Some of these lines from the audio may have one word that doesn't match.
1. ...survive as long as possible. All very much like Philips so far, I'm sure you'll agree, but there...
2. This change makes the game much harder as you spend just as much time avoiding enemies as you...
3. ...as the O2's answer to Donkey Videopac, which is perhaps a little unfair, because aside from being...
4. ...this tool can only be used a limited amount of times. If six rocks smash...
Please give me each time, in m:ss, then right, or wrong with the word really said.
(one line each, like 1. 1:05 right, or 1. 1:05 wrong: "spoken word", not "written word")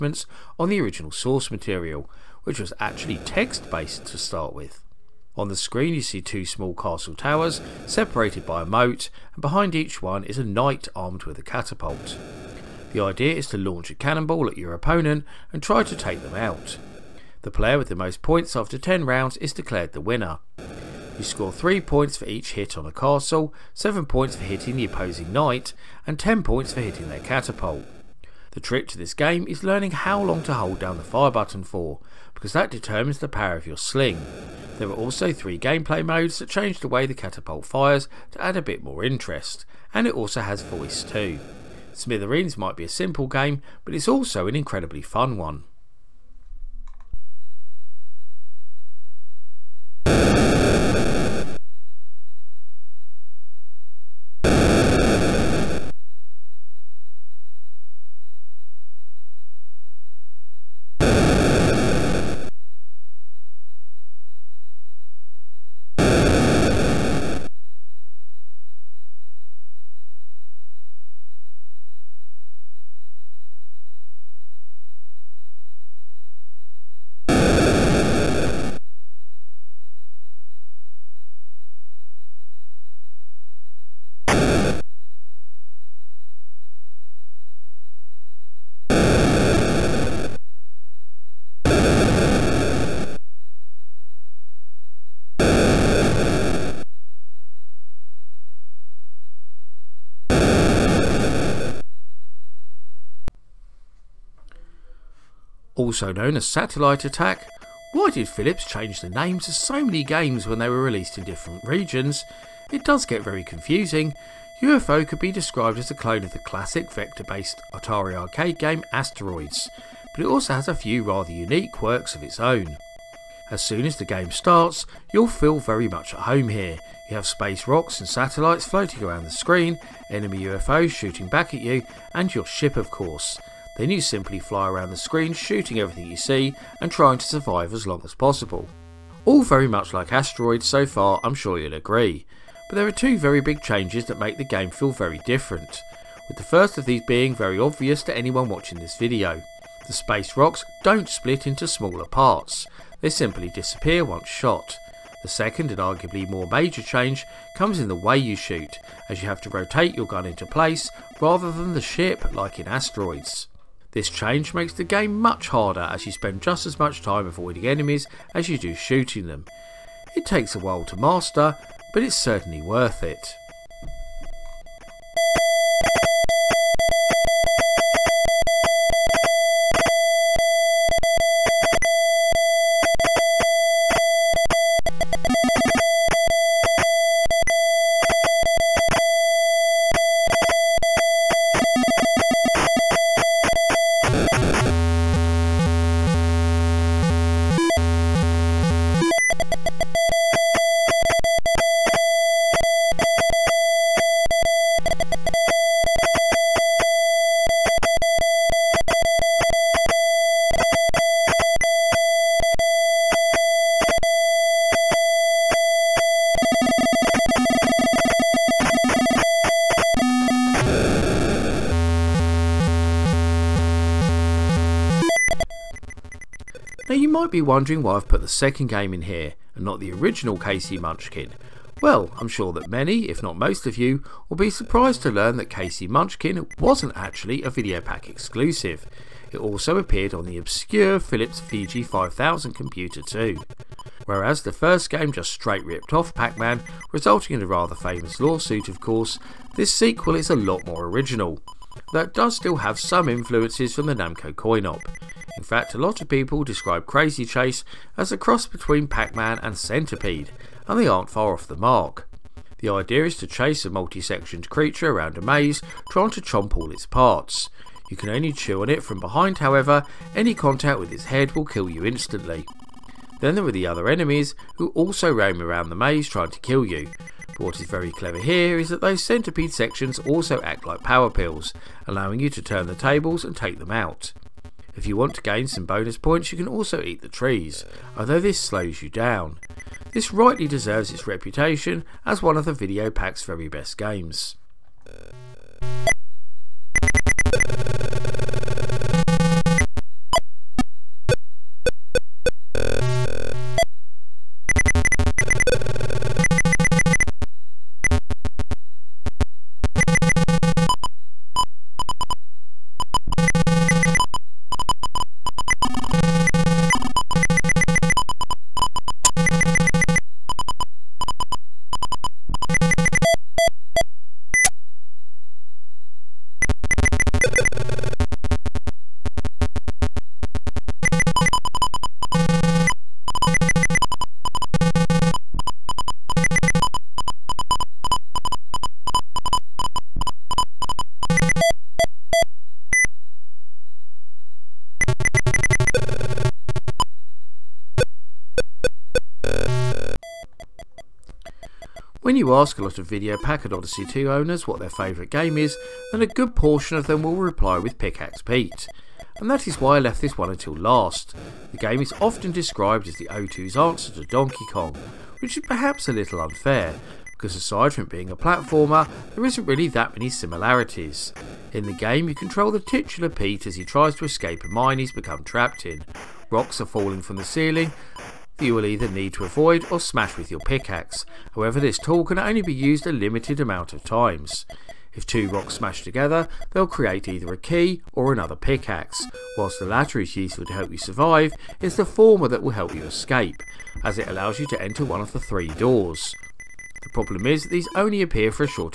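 1. 2:17 wrong: "Asteroids", not "Philips"
2. 2:43 right
3. 6:02 wrong: "Kong", not "Videopac"
4. 6:21 wrong: "two", not "six".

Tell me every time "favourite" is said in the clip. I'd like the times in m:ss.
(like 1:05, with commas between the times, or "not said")
5:54.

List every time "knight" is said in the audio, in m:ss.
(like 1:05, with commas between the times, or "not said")
0:10, 0:25.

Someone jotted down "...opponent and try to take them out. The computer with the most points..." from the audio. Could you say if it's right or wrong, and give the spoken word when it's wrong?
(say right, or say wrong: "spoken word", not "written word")
wrong: "player", not "computer".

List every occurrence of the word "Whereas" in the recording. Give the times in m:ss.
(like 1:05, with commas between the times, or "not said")
4:04.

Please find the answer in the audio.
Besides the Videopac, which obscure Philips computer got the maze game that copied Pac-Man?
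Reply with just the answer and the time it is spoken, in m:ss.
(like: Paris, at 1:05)
Philips VG 5000, at 4:01.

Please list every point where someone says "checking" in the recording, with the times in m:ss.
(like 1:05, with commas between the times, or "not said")
not said.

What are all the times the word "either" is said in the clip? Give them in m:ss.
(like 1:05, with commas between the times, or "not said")
6:18, 6:27.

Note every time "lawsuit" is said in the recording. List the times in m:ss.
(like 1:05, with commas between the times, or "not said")
4:08.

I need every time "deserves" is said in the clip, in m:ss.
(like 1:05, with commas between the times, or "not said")
4:50.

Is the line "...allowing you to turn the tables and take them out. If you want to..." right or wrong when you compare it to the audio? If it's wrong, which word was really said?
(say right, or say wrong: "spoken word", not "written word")
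right.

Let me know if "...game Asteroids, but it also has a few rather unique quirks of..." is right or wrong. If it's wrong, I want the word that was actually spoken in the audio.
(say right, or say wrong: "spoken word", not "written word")
right.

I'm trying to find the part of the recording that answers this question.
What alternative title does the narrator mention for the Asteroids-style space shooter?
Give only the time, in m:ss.
1:46.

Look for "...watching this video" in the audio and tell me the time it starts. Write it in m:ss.
2:28.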